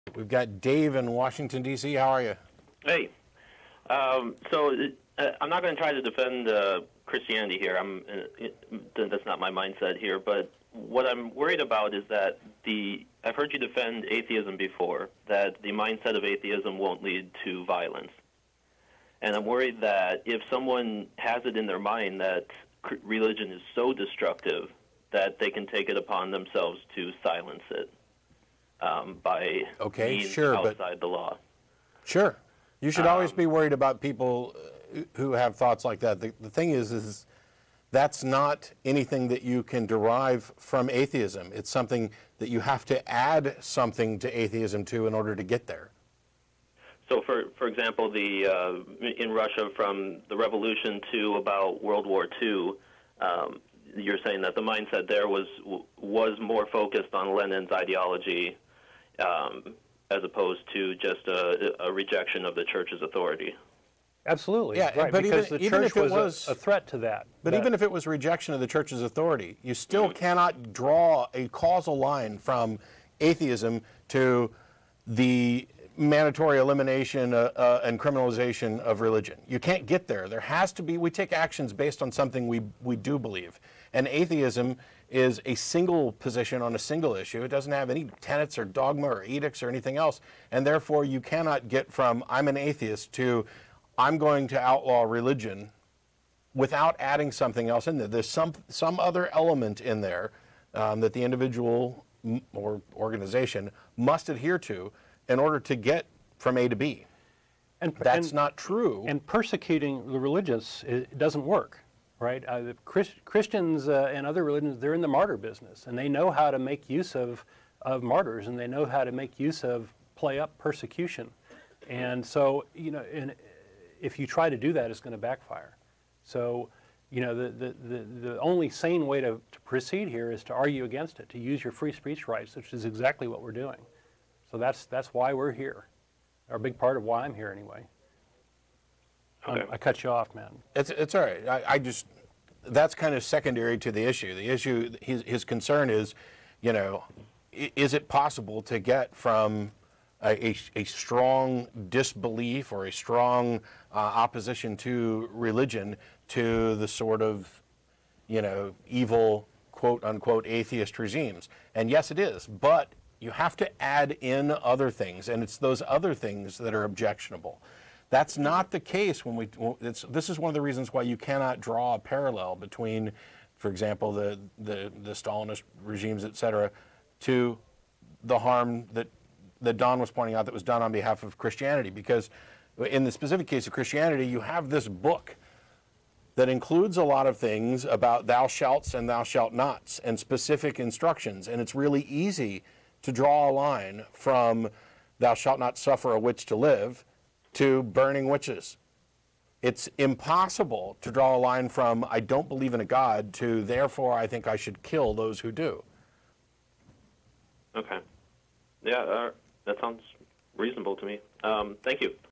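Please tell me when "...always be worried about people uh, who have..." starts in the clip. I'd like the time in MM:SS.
00:33.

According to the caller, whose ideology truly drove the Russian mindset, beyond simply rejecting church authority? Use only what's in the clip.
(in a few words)
Lenin.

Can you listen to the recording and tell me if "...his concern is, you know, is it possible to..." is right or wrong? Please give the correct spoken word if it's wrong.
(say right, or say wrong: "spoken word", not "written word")
right.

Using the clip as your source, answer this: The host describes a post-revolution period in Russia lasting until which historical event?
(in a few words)
World War II.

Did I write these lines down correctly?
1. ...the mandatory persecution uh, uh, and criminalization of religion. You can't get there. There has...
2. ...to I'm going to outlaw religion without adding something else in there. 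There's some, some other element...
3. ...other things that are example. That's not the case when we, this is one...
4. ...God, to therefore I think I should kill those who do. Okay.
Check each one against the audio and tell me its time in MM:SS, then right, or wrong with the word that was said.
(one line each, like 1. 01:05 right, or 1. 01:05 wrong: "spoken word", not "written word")
1. 01:15 wrong: "elimination", not "persecution"
2. 01:33 right
3. 02:45 wrong: "objectionable", not "example"
4. 03:22 right.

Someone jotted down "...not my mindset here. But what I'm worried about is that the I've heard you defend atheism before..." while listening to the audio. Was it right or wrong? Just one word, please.
right.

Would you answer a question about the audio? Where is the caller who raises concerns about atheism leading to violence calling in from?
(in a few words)
Washington, D.C.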